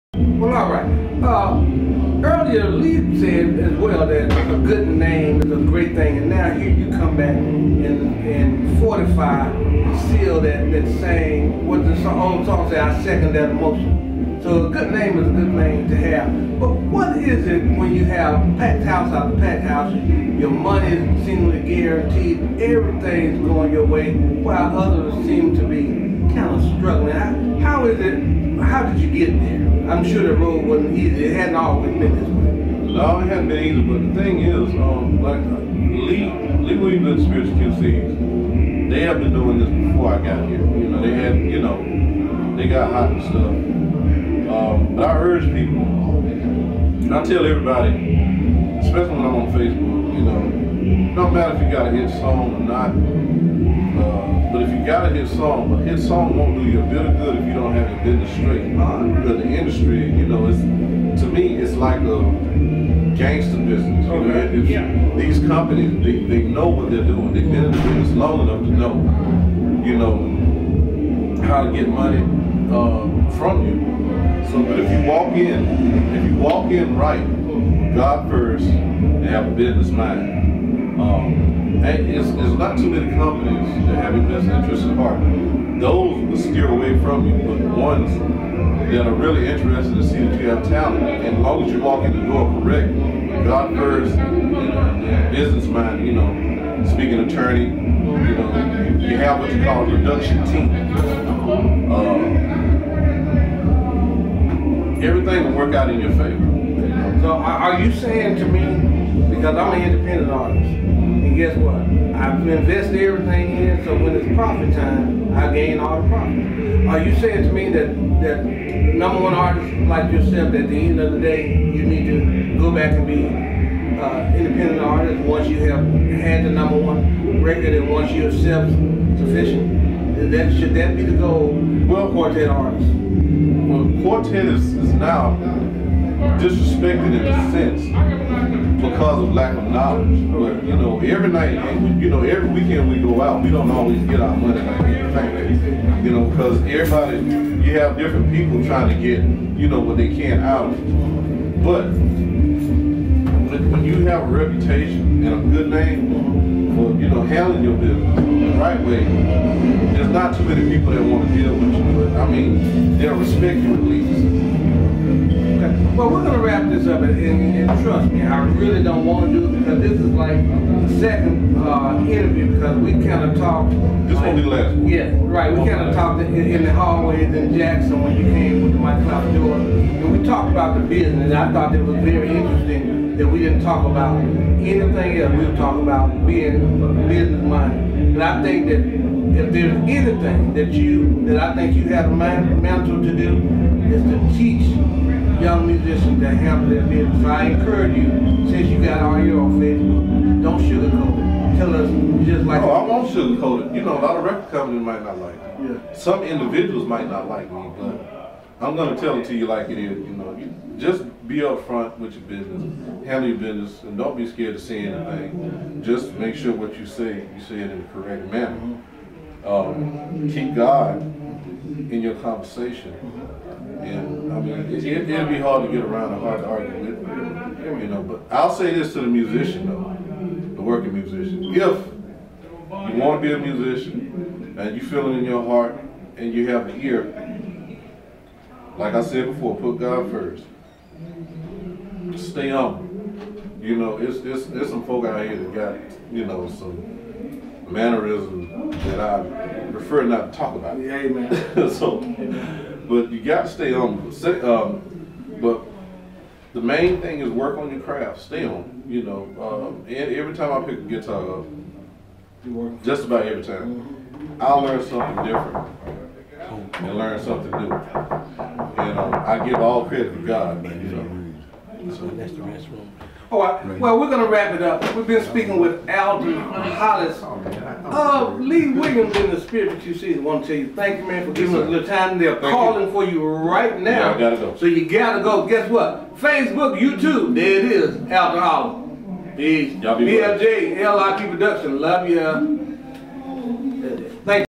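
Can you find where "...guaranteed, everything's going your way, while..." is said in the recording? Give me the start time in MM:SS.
00:21.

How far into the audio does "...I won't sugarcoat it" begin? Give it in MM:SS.
03:22.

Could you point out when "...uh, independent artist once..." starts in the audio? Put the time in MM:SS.
02:03.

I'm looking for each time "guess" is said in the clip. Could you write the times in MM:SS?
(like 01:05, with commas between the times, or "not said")
01:51, 04:45.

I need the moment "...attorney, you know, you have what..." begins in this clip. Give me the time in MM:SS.
01:37.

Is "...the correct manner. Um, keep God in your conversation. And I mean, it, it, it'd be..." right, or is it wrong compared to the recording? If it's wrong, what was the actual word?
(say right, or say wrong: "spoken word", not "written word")
right.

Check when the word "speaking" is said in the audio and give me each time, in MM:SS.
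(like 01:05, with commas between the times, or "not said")
01:36, 04:35.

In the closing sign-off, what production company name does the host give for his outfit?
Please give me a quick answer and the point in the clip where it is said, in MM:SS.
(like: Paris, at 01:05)
LIP Production, at 04:51.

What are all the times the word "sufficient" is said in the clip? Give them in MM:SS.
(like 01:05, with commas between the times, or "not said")
02:08.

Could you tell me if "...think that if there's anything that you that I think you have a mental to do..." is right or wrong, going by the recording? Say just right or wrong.
right.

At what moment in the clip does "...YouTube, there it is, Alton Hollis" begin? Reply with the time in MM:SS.
04:46.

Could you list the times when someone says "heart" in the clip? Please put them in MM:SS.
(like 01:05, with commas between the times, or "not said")
01:24, 03:55.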